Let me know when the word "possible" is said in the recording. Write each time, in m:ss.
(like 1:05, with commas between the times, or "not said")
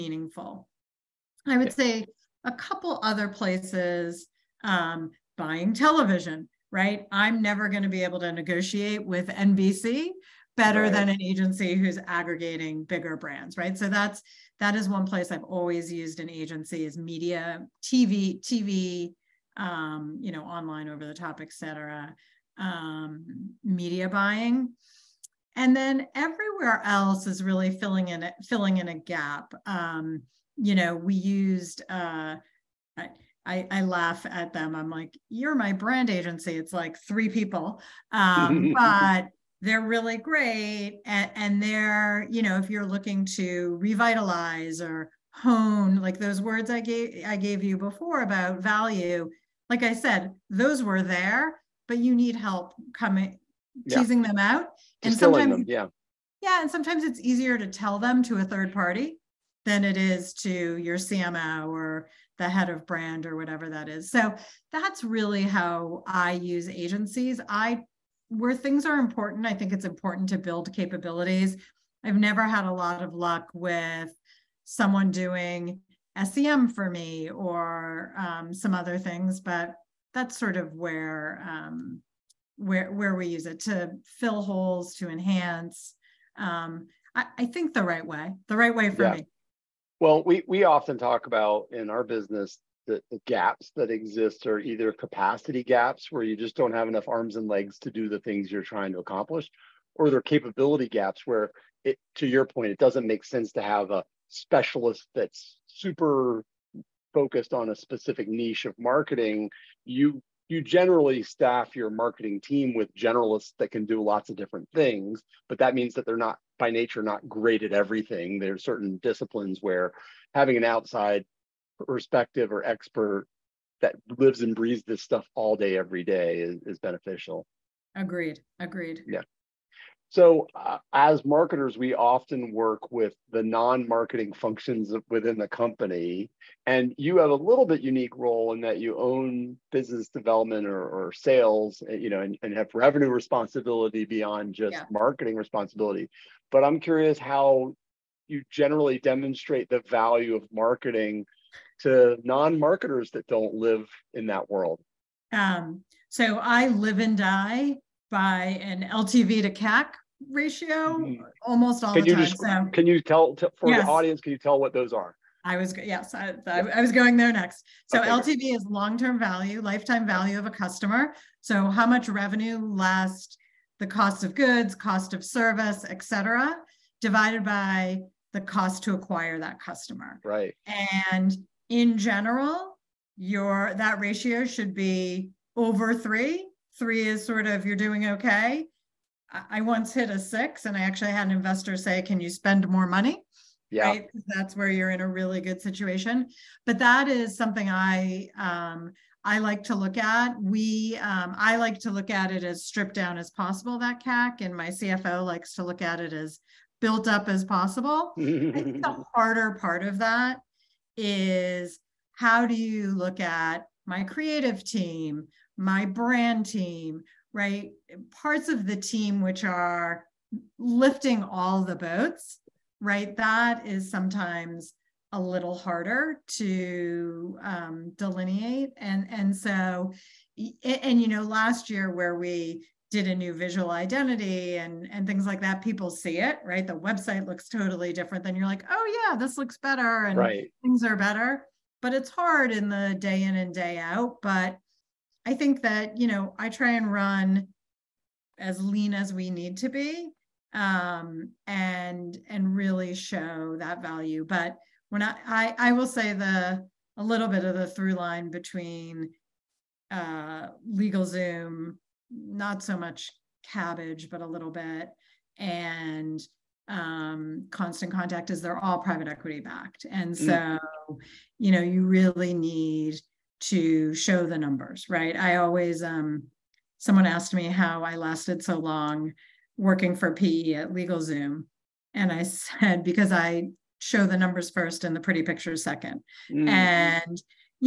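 3:23, 3:27.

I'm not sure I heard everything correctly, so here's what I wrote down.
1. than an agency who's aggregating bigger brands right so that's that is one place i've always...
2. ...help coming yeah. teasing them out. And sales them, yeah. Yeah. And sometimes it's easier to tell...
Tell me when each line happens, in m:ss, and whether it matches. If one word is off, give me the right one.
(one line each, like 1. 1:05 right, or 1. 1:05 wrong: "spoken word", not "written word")
1. 0:10 right
2. 0:52 wrong: "sometimes", not "sales".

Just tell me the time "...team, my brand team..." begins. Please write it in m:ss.
3:34.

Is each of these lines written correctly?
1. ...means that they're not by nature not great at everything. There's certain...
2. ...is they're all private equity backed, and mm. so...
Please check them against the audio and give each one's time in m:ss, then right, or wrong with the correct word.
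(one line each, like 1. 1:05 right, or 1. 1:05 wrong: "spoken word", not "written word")
1. 1:55 right
2. 4:28 right.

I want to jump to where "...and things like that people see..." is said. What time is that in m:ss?
3:54.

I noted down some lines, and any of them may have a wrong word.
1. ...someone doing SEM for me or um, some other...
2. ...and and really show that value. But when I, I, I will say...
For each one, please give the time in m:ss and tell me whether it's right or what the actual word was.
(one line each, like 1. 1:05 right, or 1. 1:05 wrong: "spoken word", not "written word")
1. 1:14 right
2. 4:11 right.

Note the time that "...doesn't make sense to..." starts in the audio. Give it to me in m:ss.
1:42.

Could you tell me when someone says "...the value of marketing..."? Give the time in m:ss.
2:29.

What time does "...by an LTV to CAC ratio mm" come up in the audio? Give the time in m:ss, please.
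2:38.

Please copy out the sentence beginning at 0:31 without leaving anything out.
Uh, I, I, laugh at them.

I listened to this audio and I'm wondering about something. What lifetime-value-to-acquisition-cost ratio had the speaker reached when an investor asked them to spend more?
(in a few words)
6.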